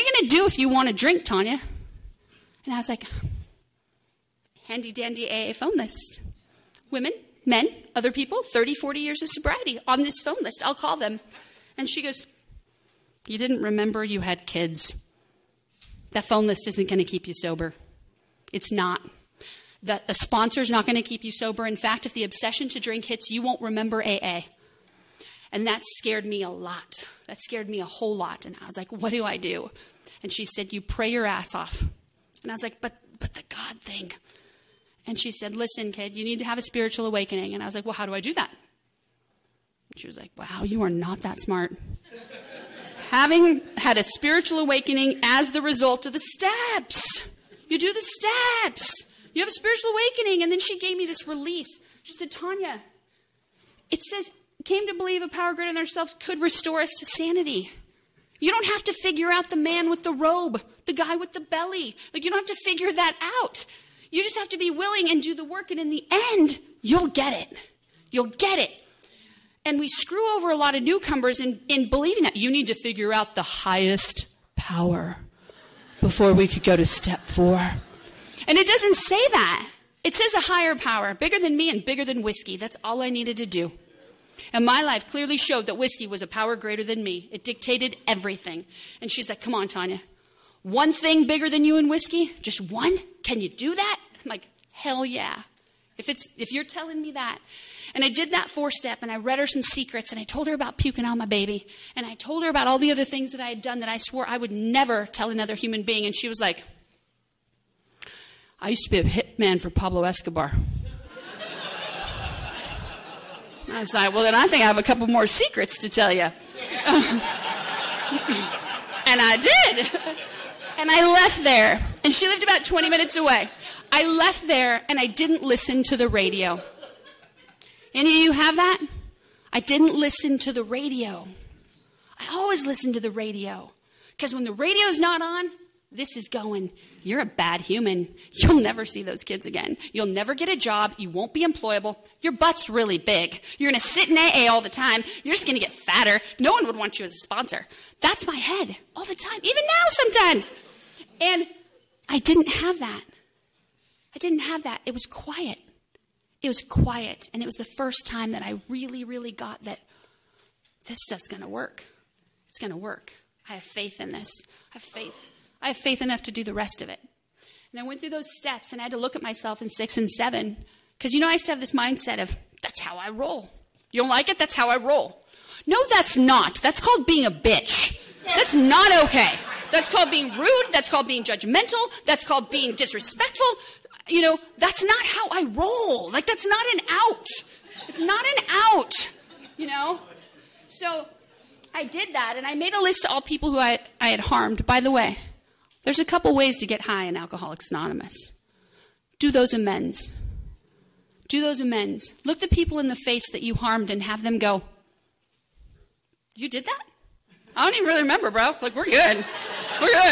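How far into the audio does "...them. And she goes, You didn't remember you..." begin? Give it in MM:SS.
00:10.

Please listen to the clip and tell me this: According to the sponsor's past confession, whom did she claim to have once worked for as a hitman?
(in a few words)
Pablo Escobar.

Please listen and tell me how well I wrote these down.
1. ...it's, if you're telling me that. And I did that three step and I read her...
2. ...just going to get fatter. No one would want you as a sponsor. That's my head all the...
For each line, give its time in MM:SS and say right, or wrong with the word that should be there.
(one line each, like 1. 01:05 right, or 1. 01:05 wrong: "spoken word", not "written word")
1. 01:36 wrong: "four", not "three"
2. 02:25 right.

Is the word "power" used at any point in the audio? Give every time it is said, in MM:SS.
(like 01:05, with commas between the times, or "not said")
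00:55, 01:14, 01:20, 01:26.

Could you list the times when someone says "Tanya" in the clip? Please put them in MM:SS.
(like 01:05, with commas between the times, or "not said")
00:01, 00:52, 01:29.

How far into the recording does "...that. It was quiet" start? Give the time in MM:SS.
02:34.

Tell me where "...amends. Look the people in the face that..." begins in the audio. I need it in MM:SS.
03:21.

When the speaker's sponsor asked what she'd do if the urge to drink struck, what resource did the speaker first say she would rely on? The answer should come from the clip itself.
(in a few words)
AA phone list.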